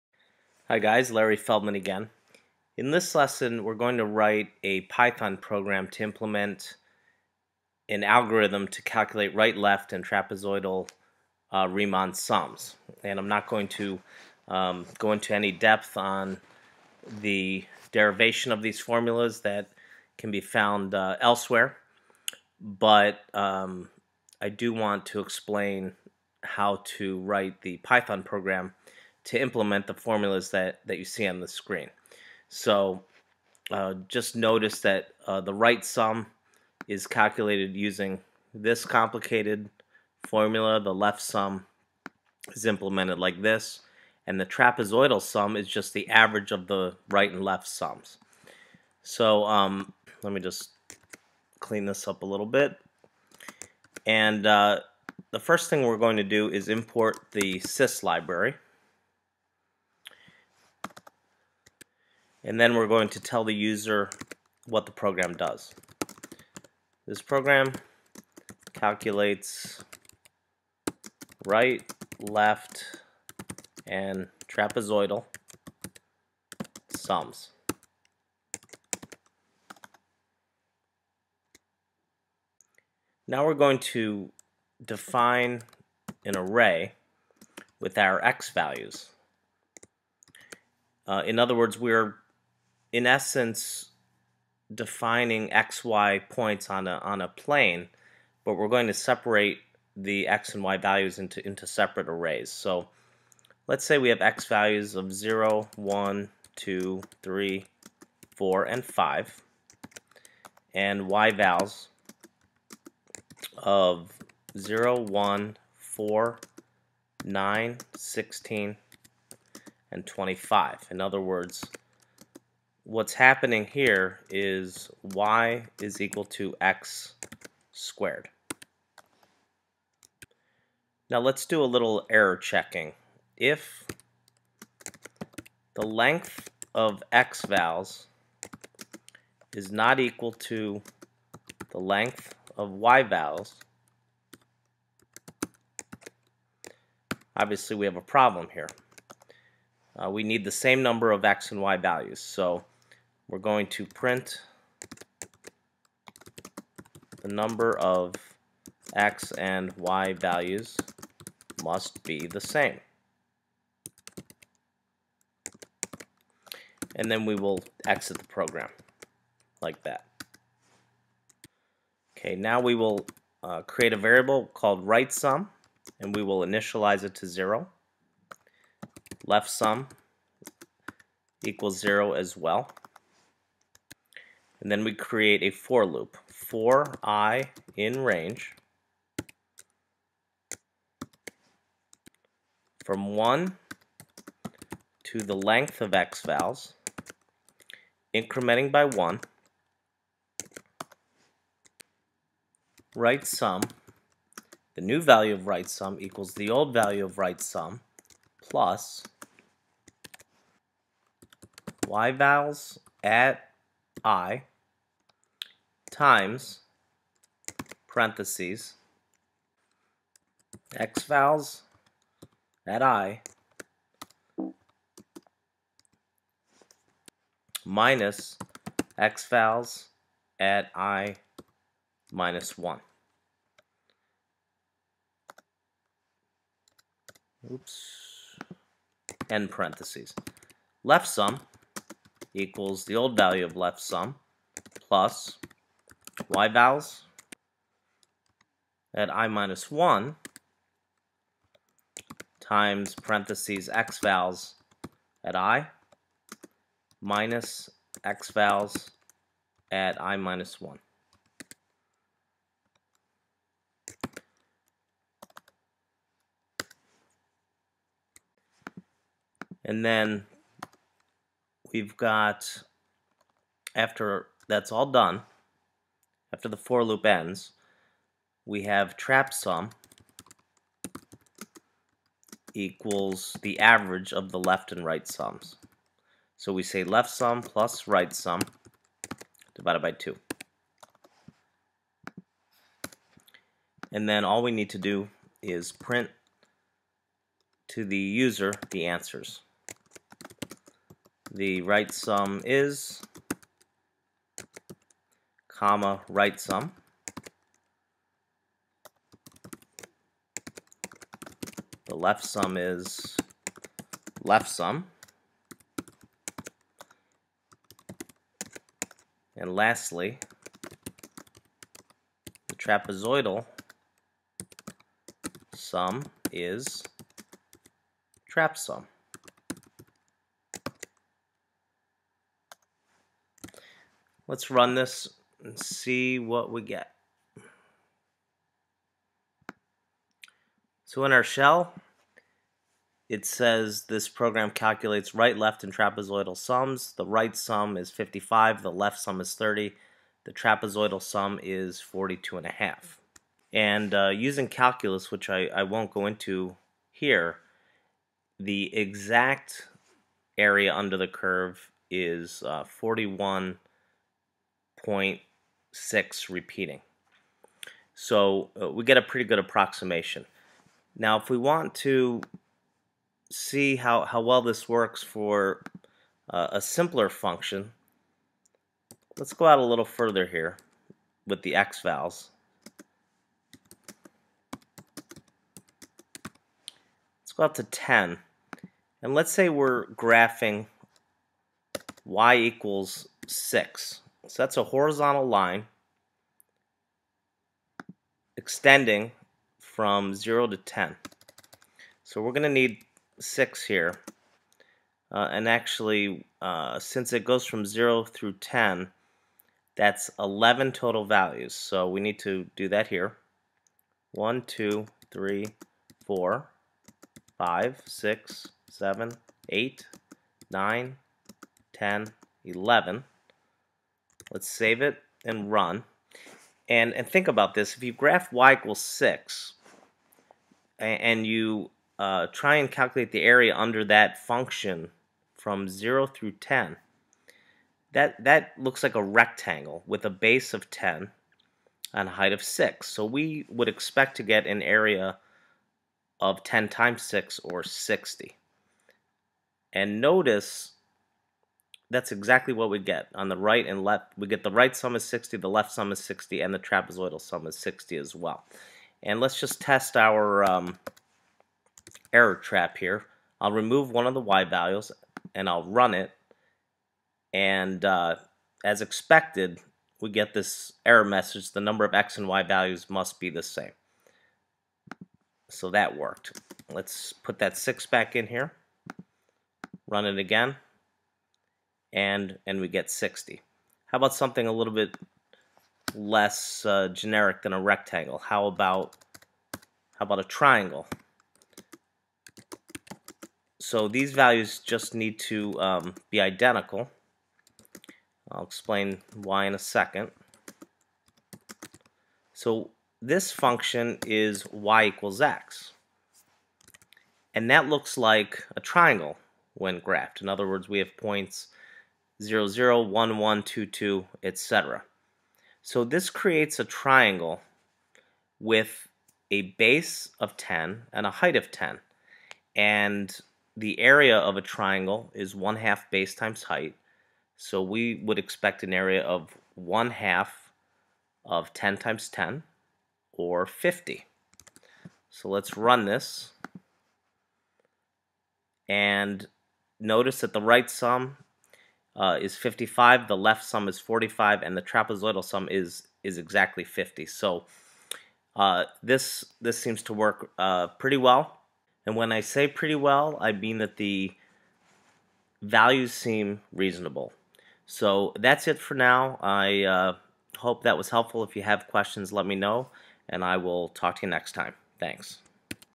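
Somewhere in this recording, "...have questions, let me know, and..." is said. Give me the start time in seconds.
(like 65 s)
561 s.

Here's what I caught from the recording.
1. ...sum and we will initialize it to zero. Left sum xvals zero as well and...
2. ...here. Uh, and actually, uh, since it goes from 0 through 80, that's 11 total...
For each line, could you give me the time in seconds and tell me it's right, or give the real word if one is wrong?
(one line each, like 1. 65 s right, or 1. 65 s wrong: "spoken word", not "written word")
1. 175 s wrong: "equals", not "xvals"
2. 403 s wrong: "10", not "80".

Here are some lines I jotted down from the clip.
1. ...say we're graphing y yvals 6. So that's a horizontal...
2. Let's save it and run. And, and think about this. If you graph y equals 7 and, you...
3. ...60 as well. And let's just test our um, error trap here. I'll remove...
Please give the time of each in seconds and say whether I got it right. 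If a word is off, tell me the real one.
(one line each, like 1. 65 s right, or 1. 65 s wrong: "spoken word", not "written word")
1. 389 s wrong: "equals", not "yvals"
2. 424 s wrong: "6", not "7"
3. 457 s right.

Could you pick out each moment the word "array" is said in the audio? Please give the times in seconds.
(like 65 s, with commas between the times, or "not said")
86 s, 102 s.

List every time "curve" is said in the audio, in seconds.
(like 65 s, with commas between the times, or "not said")
361 s.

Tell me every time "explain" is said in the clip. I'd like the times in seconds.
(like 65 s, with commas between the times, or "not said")
25 s, 498 s.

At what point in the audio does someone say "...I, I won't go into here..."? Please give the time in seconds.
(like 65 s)
355 s.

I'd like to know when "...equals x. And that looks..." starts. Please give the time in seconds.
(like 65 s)
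504 s.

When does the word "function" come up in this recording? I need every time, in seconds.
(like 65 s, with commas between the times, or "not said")
377 s, 434 s, 503 s.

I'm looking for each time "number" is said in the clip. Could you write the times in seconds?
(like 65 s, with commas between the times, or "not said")
150 s, 157 s, 471 s.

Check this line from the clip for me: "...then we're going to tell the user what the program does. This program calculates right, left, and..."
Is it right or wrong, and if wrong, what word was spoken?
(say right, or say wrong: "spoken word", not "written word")
right.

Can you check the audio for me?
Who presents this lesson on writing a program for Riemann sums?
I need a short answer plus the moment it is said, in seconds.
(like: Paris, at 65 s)
Larry Feldman, at 1 s.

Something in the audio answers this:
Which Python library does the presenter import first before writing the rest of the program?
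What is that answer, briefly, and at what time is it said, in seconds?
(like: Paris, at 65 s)
sys, at 57 s.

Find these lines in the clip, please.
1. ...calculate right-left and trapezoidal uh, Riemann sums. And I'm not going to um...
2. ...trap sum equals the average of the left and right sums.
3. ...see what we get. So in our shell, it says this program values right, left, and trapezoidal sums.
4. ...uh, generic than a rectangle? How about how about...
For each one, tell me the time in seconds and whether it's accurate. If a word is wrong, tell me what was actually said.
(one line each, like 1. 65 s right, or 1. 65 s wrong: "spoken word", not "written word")
1. 8 s right
2. 278 s right
3. 335 s wrong: "calculates", not "values"
4. 486 s right.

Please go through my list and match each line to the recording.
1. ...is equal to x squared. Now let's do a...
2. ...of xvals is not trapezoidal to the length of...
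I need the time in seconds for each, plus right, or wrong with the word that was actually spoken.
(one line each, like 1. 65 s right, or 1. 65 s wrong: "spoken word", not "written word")
1. 125 s right
2. 136 s wrong: "equal", not "trapezoidal".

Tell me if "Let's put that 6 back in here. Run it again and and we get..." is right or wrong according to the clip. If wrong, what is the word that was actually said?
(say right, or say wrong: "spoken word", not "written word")
right.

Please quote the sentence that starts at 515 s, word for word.
So this creates a triangle with a base of 10 and a height of 10.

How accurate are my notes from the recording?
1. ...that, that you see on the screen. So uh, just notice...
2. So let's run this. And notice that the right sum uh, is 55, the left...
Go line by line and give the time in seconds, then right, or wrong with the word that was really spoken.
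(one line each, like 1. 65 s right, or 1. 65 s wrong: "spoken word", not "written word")
1. 30 s right
2. 535 s right.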